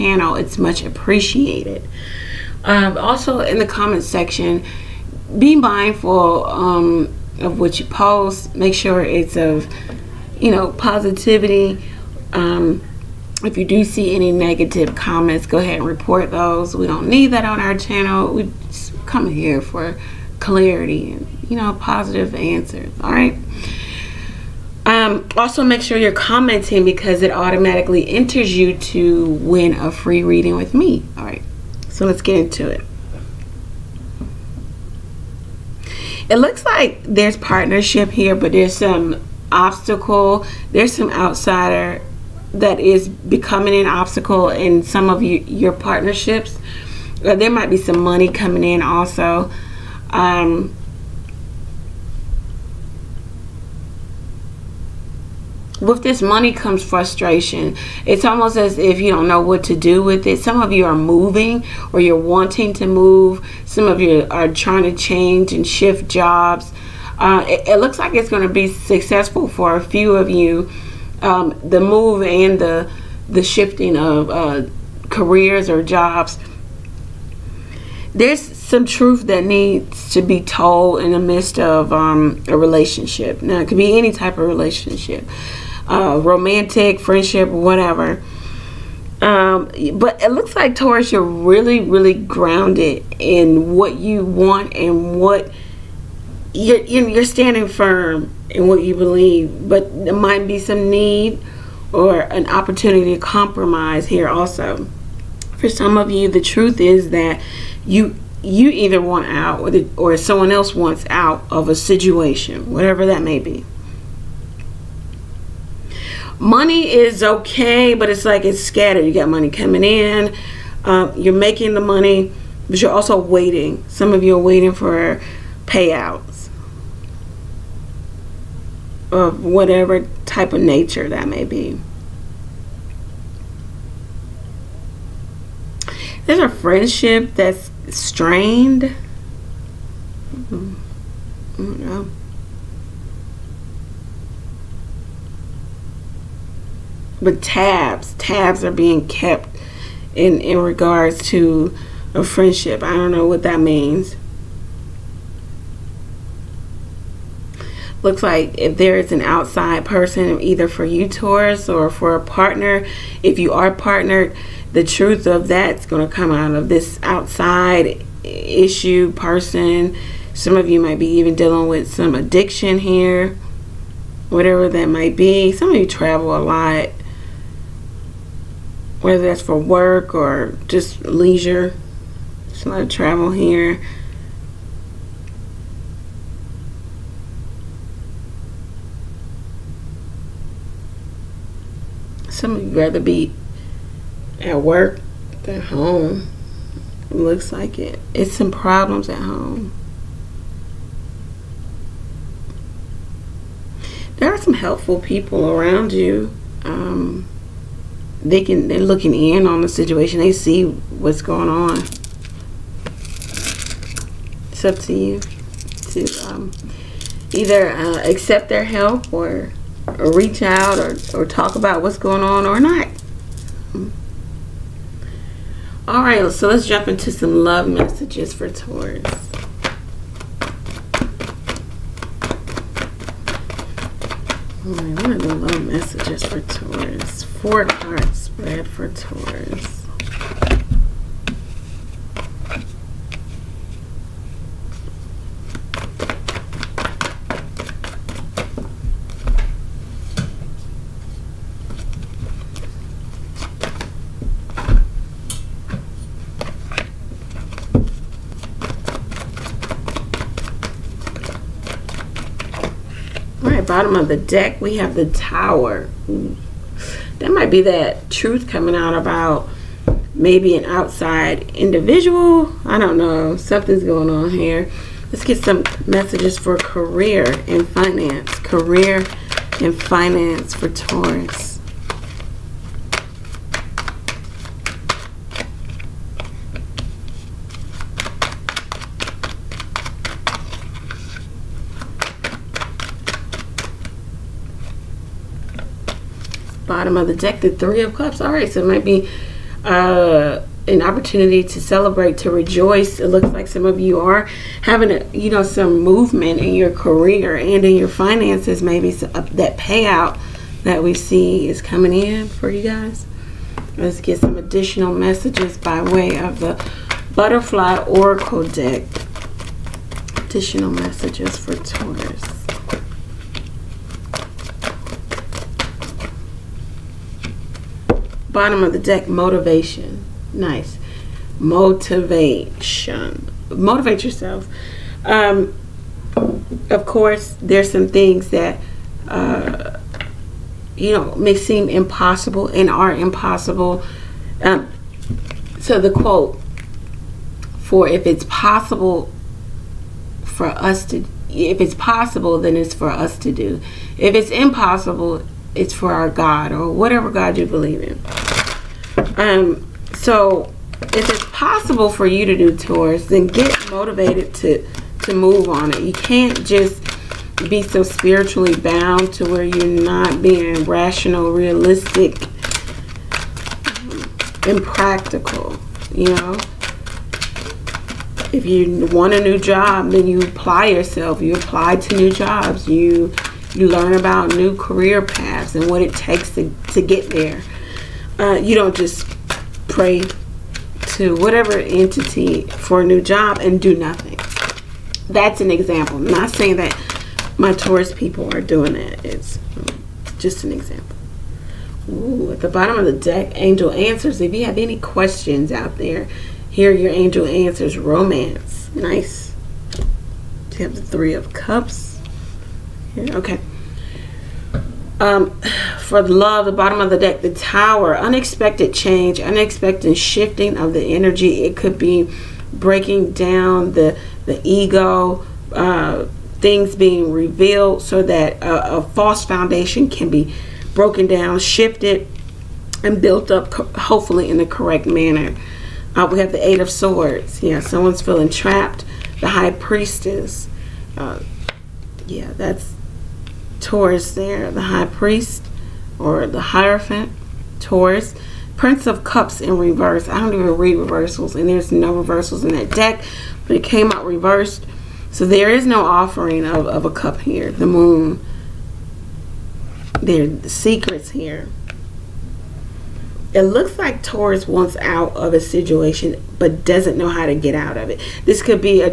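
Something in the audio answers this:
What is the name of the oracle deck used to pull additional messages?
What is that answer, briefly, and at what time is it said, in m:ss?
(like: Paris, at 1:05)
Butterfly Oracle, at 5:17.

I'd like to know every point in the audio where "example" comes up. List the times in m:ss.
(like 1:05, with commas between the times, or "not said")
6:35, 6:40.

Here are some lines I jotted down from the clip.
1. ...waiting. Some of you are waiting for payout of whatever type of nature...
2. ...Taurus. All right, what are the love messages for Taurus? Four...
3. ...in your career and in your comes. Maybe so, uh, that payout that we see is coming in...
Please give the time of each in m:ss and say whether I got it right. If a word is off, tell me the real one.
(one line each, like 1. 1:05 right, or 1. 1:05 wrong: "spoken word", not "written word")
1. 2:03 right
2. 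3:48 right
3. 5:06 wrong: "finances", not "comes".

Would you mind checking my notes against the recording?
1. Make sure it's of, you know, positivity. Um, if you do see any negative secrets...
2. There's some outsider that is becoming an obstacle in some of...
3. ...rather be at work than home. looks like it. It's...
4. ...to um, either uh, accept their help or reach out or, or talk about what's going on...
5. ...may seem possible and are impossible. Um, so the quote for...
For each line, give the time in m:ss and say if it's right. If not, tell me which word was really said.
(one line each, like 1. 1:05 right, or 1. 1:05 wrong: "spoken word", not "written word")
1. 0:08 wrong: "comments", not "secrets"
2. 0:40 right
3. 3:12 right
4. 3:35 right
5. 5:41 wrong: "impossible", not "possible".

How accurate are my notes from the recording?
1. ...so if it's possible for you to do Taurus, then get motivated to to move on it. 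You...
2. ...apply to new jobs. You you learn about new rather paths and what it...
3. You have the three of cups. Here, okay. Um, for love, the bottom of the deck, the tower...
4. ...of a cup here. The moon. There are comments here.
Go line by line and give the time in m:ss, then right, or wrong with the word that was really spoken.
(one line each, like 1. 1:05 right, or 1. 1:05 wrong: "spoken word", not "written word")
1. 5:59 right
2. 6:21 wrong: "career", not "rather"
3. 6:50 right
4. 7:36 wrong: "secrets", not "comments".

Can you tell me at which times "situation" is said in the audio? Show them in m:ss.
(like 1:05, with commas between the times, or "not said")
1:51, 3:29, 7:45.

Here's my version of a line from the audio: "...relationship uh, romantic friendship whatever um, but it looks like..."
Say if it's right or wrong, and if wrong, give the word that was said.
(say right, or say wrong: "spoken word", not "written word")
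right.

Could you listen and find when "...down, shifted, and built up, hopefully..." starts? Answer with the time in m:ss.
7:11.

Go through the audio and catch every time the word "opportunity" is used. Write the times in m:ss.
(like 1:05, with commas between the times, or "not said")
1:42, 5:00.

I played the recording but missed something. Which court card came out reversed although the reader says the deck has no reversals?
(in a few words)
Prince of Cups.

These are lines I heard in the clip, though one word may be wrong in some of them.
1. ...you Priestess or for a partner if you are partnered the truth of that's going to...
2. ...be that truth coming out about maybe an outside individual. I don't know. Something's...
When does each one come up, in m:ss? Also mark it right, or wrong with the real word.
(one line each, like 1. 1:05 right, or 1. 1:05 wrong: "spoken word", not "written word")
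1. 2:40 wrong: "Taurus", not "Priestess"
2. 4:27 right.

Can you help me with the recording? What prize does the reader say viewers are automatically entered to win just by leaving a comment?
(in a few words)
A free reading.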